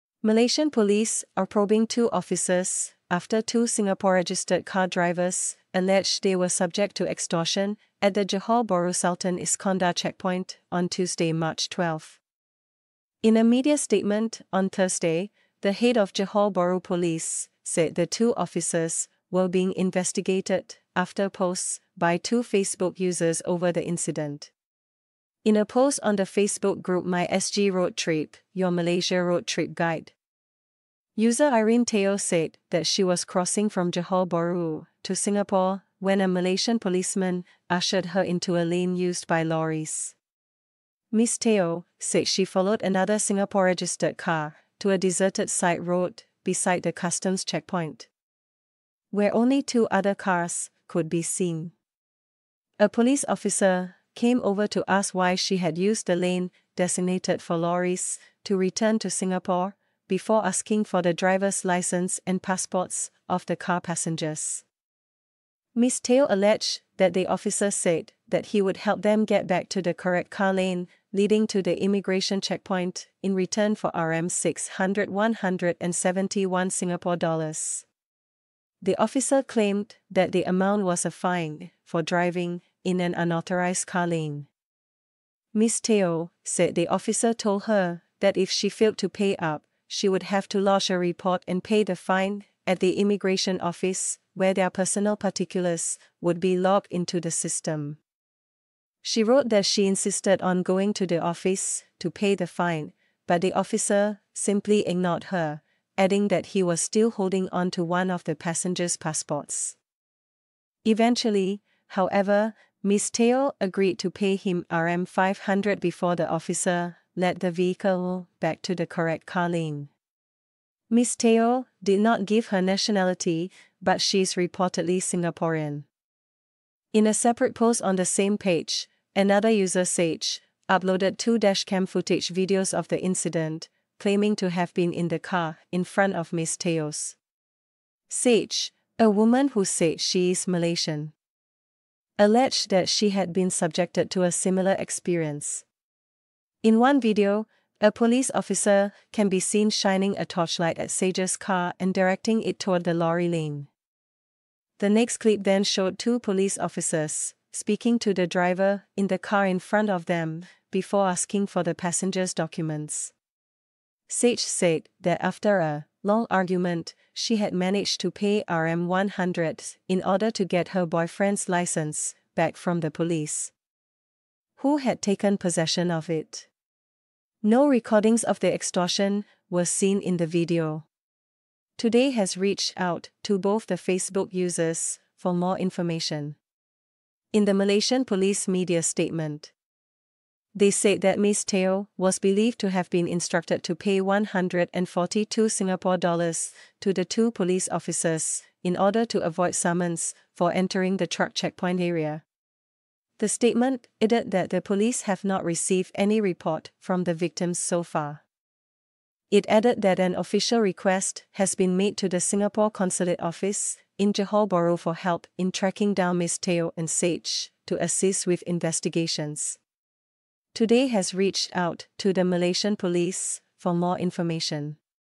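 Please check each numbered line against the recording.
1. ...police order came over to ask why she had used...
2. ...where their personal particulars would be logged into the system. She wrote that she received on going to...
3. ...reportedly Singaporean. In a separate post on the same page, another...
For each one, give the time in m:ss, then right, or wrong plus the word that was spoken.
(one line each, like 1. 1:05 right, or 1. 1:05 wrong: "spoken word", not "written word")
1. 0:52 wrong: "officer", not "order"
2. 1:34 wrong: "insisted", not "received"
3. 2:04 right.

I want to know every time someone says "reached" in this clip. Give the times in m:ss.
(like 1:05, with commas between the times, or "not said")
3:02, 3:41.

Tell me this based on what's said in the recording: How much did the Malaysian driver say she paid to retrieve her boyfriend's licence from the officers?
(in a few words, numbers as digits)
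RM 100.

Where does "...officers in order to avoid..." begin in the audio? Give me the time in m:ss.
3:17.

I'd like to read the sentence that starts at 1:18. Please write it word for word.
The officer claimed that the amount was a fine for driving in an unauthorized calling.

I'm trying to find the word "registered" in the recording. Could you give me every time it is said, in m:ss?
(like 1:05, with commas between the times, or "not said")
0:04, 0:43.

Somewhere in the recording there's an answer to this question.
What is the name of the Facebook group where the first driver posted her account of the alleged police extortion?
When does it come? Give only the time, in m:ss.
0:27.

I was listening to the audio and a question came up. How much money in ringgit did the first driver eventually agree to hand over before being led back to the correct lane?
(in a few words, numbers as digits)
RM 500.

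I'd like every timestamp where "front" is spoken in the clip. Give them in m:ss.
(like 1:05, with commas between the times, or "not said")
2:15, 2:39.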